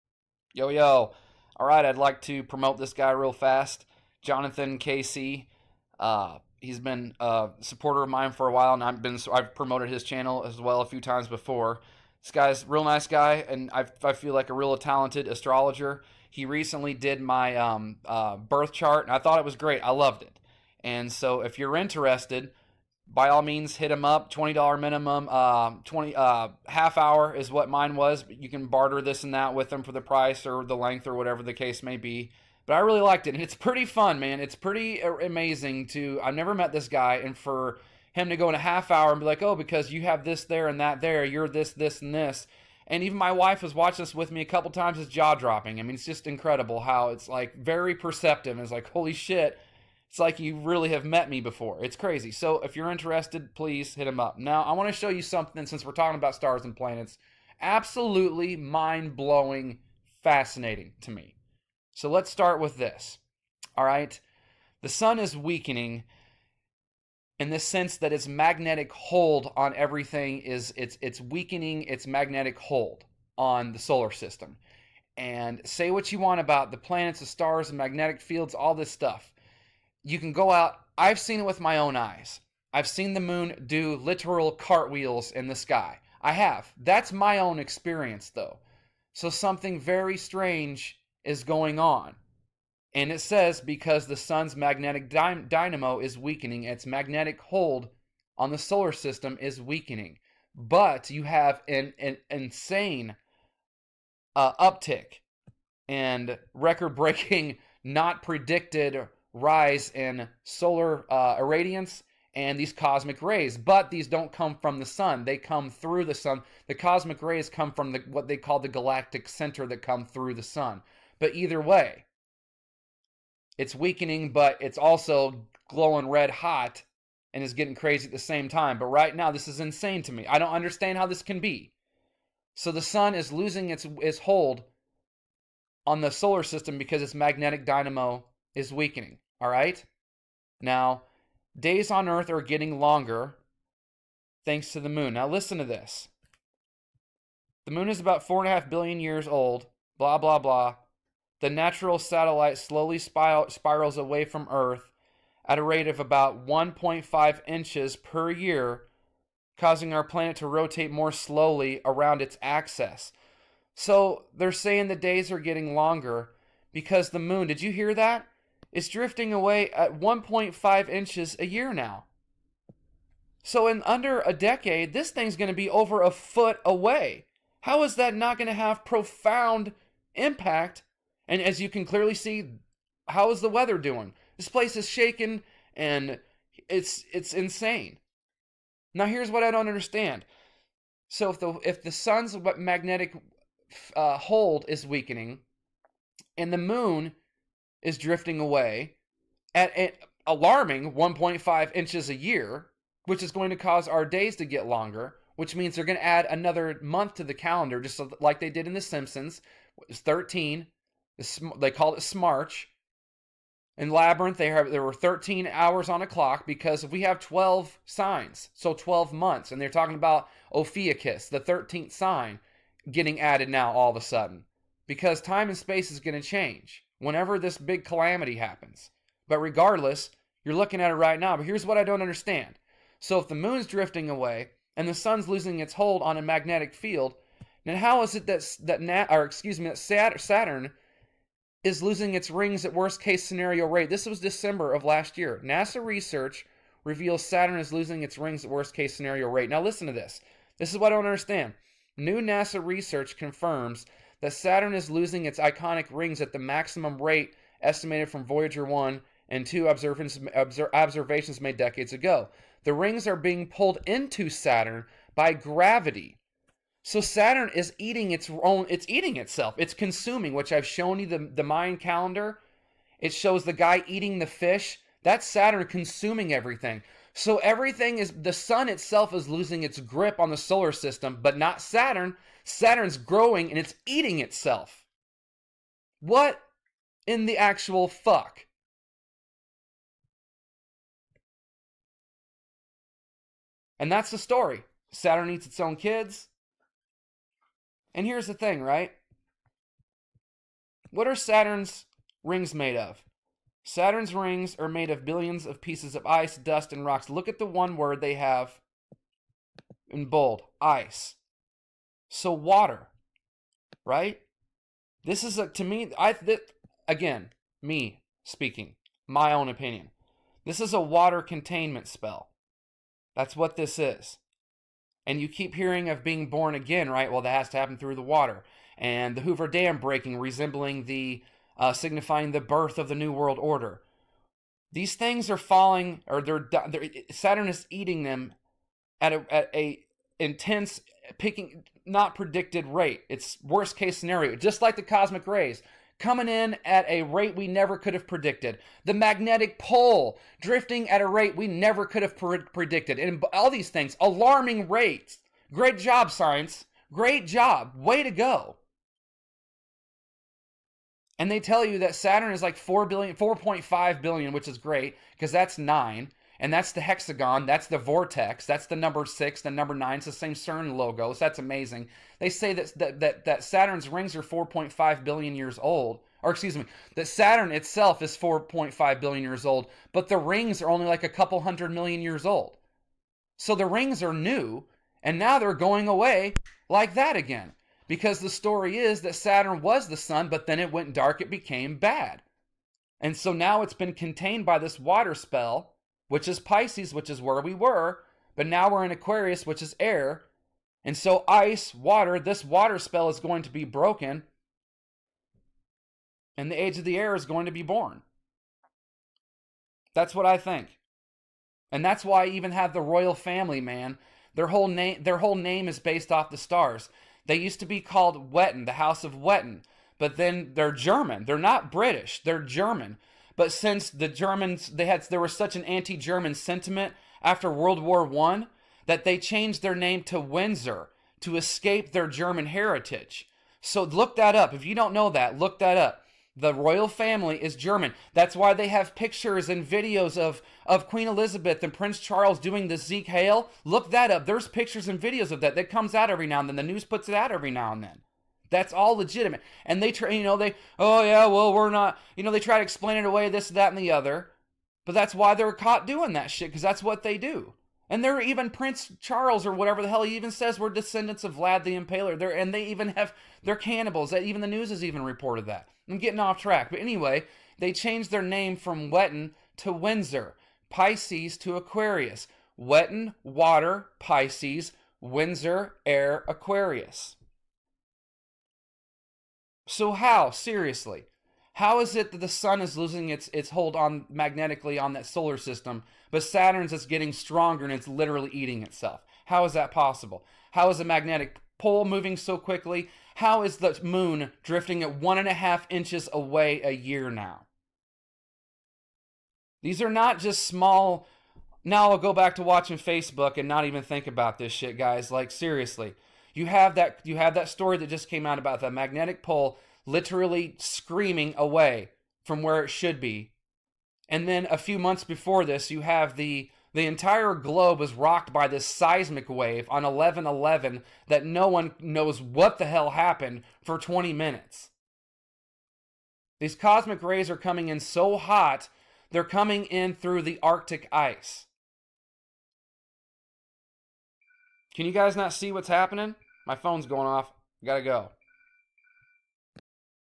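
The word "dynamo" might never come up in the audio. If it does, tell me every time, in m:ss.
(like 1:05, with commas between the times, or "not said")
1:35, 2:17.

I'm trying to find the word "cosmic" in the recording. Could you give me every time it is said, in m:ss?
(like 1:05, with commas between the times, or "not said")
1:52, 1:56, 5:44, 8:46.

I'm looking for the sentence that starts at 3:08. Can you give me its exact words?
Now here's what I don't understand.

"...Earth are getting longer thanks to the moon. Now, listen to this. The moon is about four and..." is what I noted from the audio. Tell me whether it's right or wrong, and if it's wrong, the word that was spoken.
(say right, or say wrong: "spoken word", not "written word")
right.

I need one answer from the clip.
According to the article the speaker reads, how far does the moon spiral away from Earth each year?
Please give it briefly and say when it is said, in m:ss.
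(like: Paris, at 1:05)
1.5 inches, at 2:36.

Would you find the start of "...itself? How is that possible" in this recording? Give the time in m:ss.
8:08.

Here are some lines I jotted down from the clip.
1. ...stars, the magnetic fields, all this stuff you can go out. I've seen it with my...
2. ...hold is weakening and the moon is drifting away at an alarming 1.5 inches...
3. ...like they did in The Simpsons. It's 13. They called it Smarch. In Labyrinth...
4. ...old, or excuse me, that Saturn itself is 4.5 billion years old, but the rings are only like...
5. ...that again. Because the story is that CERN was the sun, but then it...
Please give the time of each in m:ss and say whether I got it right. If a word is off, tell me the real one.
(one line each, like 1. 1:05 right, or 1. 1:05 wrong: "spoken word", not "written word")
1. 1:17 right
2. 3:14 right
3. 3:28 right
4. 6:15 right
5. 6:26 wrong: "Saturn", not "CERN".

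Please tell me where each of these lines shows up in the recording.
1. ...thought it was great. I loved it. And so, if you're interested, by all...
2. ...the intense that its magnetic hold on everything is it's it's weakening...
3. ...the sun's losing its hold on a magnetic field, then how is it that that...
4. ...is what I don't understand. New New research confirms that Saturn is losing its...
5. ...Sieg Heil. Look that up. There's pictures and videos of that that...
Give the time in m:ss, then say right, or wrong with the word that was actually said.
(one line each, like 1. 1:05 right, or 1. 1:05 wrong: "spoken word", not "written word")
1. 0:19 right
2. 1:07 wrong: "sense", not "intense"
3. 3:54 right
4. 4:10 wrong: "NASA", not "New"
5. 7:22 right.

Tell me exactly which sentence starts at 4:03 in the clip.
This was December of last year.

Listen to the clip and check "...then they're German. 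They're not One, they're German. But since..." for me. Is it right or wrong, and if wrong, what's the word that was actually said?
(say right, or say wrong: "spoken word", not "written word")
wrong: "British", not "One".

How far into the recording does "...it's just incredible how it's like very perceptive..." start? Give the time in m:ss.
0:45.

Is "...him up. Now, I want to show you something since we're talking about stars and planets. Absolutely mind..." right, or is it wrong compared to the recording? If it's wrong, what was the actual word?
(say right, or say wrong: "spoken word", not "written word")
right.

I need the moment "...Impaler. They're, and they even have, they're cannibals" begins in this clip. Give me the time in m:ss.
7:41.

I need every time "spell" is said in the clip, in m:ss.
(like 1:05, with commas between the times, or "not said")
5:21, 6:35, 6:42.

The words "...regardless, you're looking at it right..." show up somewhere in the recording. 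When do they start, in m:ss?
3:49.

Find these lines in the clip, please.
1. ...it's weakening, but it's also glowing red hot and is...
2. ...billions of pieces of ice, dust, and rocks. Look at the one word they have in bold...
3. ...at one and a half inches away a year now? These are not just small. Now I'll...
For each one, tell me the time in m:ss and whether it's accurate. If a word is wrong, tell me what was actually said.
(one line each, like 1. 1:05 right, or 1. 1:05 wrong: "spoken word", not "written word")
1. 2:03 right
2. 5:05 right
3. 8:14 right.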